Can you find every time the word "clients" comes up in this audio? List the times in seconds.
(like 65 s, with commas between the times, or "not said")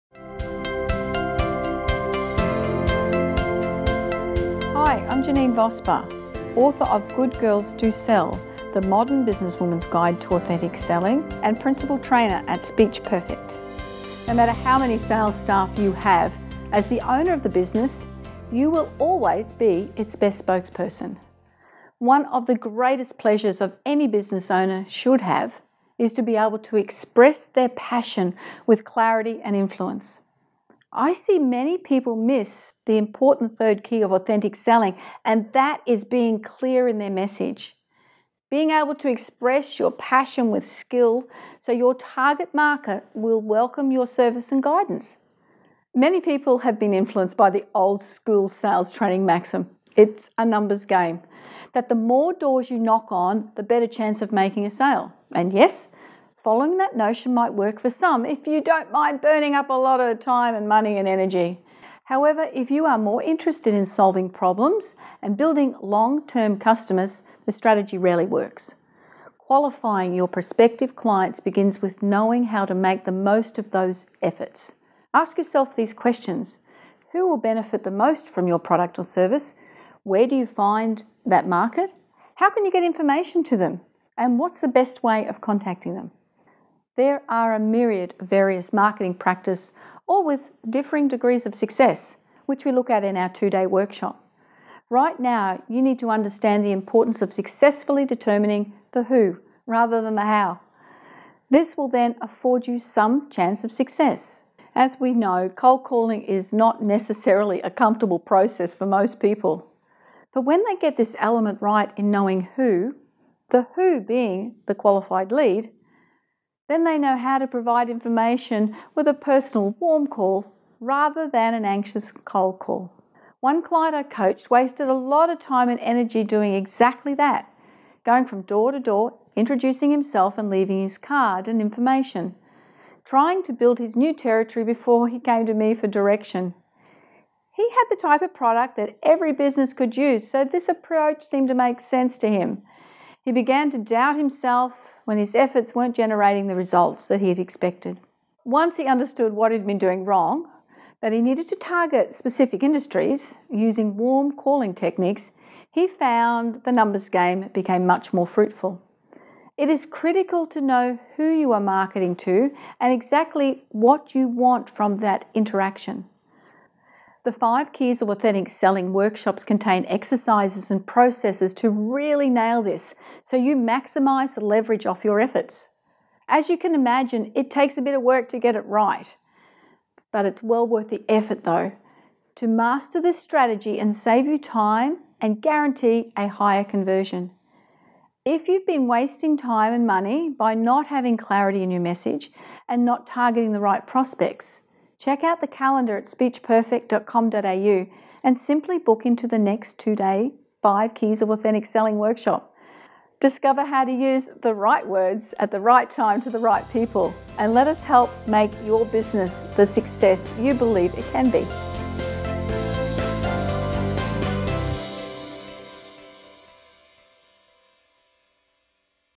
70 s, 123 s.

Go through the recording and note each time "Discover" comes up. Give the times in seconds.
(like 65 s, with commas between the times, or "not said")
203 s.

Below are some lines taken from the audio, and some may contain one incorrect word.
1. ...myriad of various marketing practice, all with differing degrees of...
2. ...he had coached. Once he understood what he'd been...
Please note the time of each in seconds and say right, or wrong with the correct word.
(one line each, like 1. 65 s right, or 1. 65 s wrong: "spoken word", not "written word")
1. 87 s right
2. 147 s wrong: "expected", not "coached".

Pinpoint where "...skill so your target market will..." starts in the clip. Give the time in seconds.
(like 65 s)
40 s.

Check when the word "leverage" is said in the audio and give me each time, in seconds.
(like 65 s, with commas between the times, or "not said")
174 s.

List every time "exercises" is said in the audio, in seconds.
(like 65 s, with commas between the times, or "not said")
169 s.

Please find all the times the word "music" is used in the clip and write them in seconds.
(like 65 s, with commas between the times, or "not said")
not said.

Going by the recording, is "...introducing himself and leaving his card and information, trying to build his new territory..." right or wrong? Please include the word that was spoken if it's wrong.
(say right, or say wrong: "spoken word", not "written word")
right.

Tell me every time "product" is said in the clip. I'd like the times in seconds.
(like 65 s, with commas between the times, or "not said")
78 s, 138 s.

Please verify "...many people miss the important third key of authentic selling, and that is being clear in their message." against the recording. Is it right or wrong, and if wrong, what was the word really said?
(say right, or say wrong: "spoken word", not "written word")
right.